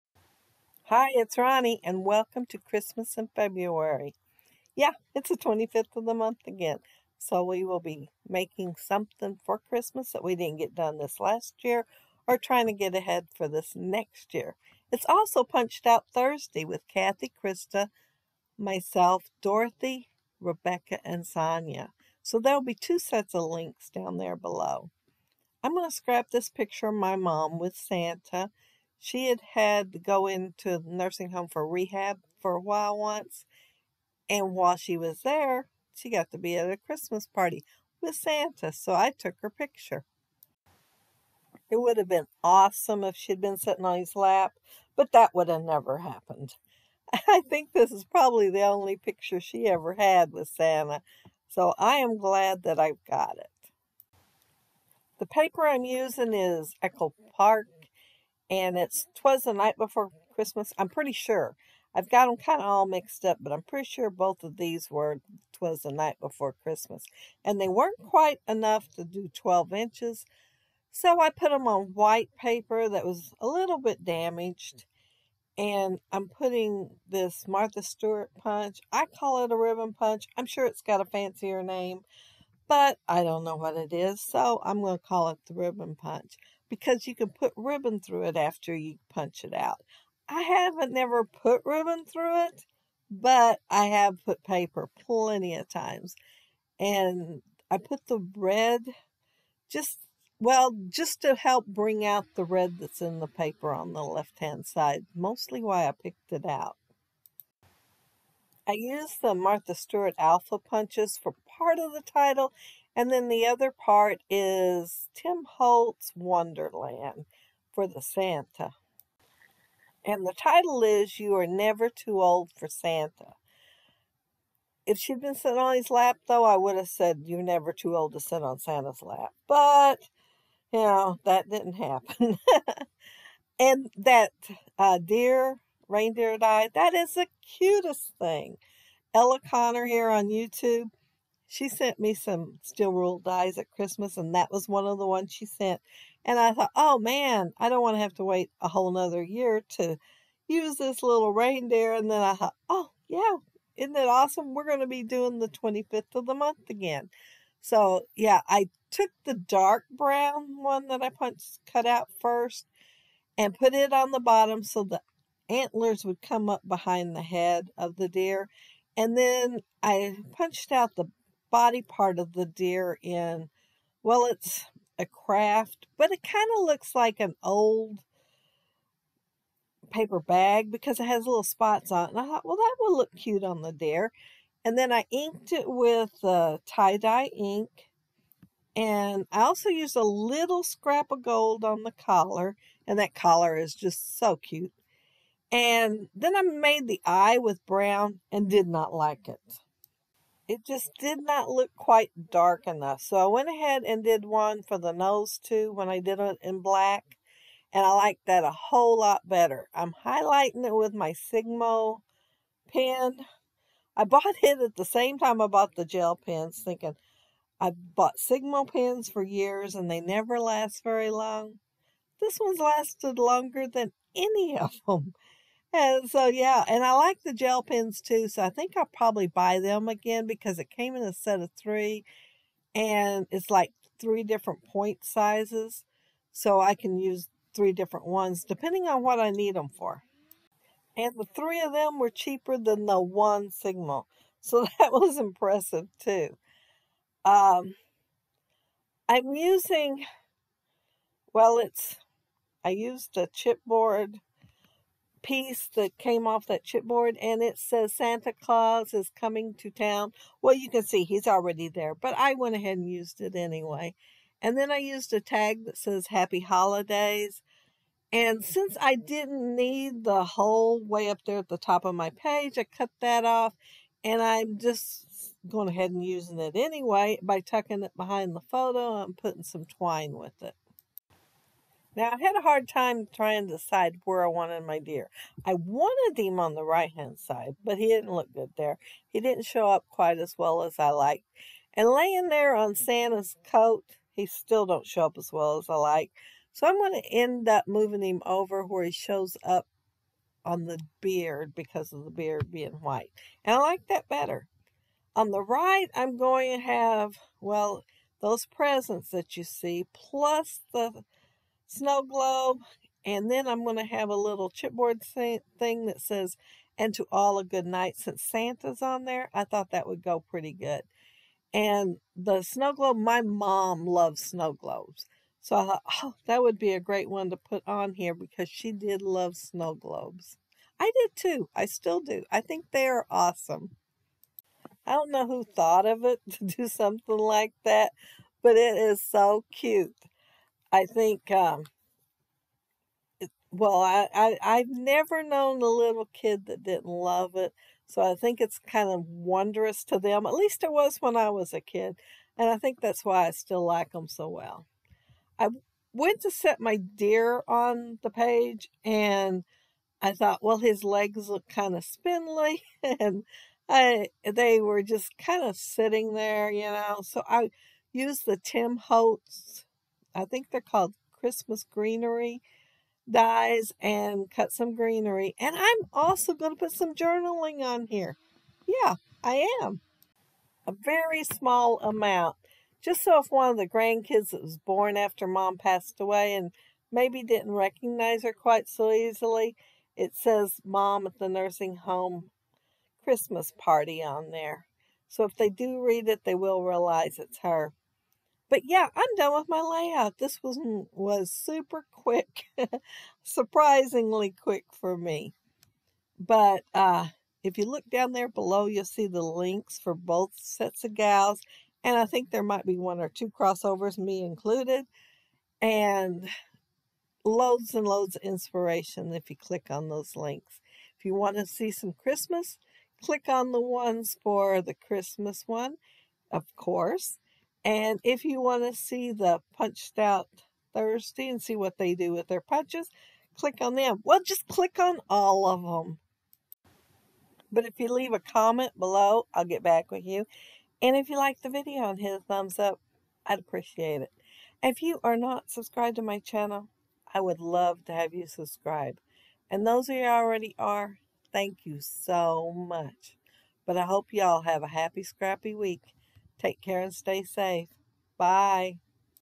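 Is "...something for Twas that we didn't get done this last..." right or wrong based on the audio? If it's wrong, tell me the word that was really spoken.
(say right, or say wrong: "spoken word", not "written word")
wrong: "Christmas", not "Twas".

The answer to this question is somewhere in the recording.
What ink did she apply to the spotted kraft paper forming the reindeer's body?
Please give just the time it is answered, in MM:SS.
03:06.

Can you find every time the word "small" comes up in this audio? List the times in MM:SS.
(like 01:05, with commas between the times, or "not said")
06:21.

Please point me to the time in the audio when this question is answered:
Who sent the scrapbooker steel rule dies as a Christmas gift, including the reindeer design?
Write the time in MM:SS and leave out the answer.
02:19.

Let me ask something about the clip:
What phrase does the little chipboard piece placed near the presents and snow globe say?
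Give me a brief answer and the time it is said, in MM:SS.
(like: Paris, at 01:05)
And to all a good night, at 05:16.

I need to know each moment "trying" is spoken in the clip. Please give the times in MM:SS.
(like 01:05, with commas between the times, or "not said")
00:12, 04:43.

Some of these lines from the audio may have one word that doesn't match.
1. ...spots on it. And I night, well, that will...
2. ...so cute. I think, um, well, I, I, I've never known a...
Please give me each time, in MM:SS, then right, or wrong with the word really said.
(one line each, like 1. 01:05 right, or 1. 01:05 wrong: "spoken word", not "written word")
1. 03:01 wrong: "thought", not "night"
2. 05:39 right.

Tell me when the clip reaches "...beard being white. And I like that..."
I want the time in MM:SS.
05:02.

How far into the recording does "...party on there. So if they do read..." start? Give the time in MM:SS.
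06:33.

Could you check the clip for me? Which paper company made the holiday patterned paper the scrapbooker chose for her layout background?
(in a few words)
Echo Park.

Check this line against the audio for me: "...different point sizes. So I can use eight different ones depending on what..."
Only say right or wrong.
wrong.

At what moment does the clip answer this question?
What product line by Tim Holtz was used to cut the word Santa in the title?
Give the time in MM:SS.
01:56.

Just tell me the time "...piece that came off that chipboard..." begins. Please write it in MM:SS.
04:15.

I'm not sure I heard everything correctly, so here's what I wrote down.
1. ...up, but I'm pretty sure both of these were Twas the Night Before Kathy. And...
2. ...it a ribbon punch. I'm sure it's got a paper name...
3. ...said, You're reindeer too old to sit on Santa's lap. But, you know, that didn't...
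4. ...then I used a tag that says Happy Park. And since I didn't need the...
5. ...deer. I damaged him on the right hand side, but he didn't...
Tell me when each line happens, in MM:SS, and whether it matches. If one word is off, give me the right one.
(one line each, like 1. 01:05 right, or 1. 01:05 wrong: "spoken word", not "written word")
1. 01:03 wrong: "Christmas", not "Kathy"
2. 01:19 wrong: "fancier", not "paper"
3. 02:06 wrong: "never", not "reindeer"
4. 04:24 wrong: "Holidays", not "Park"
5. 04:44 wrong: "wanted", not "damaged".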